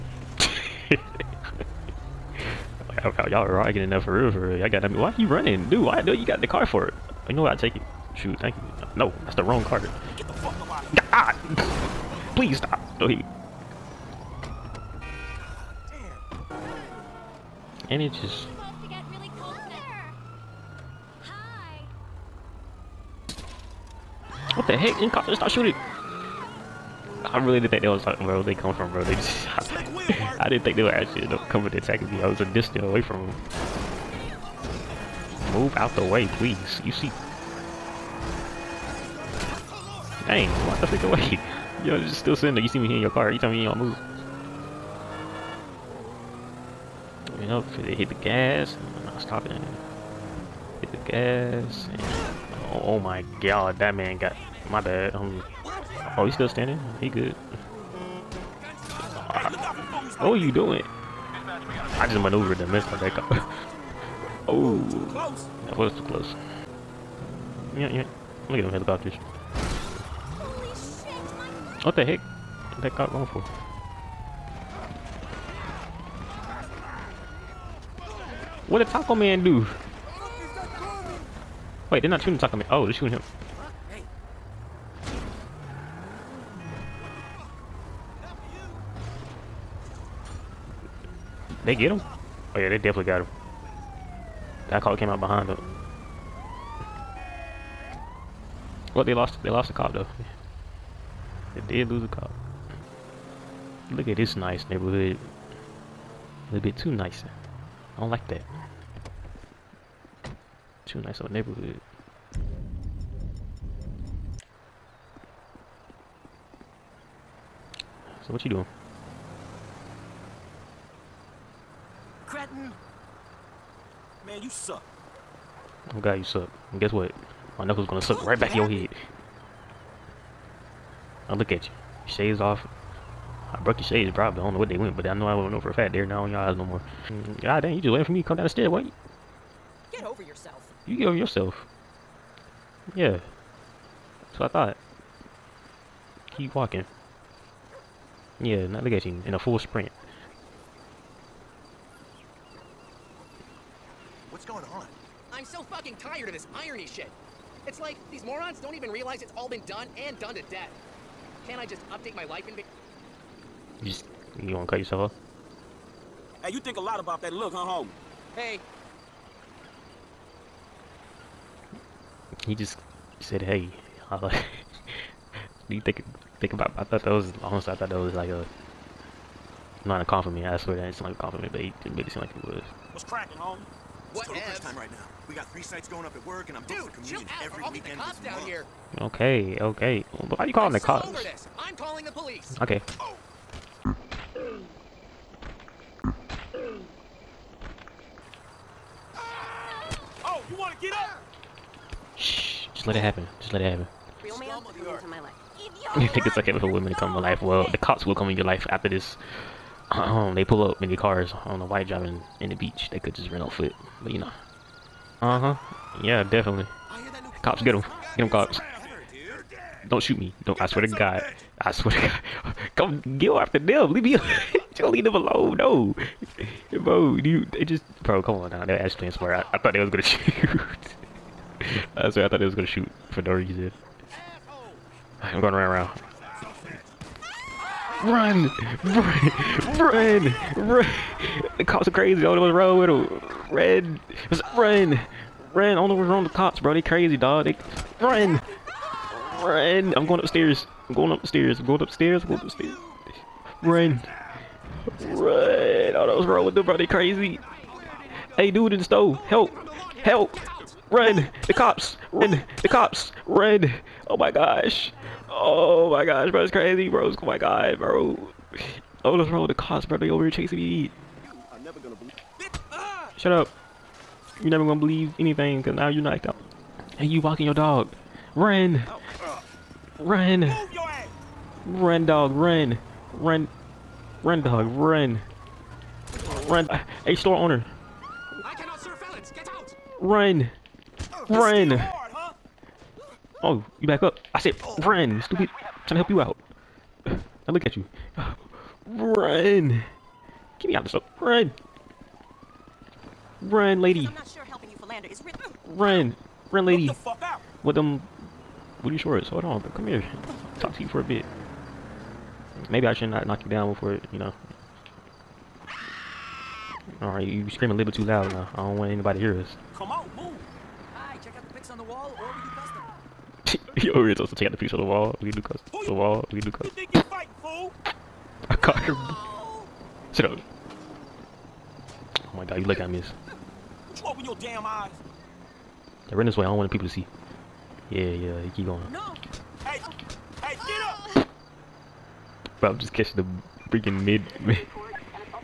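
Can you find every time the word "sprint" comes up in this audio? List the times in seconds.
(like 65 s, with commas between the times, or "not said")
149 s.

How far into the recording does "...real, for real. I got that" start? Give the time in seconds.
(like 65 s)
4 s.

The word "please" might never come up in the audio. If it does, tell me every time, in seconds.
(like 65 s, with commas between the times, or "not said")
12 s, 36 s.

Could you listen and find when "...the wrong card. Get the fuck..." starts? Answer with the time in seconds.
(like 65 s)
9 s.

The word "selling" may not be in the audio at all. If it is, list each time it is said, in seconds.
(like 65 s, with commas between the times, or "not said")
not said.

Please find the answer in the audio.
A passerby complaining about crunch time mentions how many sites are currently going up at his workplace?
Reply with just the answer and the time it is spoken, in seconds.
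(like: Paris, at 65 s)
3, at 185 s.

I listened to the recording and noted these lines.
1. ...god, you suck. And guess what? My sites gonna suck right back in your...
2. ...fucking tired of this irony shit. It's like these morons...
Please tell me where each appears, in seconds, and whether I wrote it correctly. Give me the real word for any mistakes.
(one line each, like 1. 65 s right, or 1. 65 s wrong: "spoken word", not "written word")
1. 126 s wrong: "knuckles", not "sites"
2. 155 s right.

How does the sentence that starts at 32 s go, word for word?
I was a distance away from them.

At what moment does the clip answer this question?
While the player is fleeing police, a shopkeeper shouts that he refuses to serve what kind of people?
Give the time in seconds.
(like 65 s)
288 s.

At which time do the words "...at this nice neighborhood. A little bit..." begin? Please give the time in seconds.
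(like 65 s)
104 s.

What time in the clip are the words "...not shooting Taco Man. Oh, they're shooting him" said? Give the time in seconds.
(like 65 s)
82 s.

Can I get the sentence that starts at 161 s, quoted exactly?
Can't I just update my life and be you just you wanna cut yourself off?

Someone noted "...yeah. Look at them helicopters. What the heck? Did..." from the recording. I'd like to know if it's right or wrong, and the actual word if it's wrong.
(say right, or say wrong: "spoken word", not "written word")
right.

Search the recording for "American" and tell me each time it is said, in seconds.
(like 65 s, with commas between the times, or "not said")
not said.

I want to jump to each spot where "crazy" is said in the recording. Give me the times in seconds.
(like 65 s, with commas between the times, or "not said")
241 s, 246 s, 256 s, 266 s.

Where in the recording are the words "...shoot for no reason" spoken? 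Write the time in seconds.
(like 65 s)
232 s.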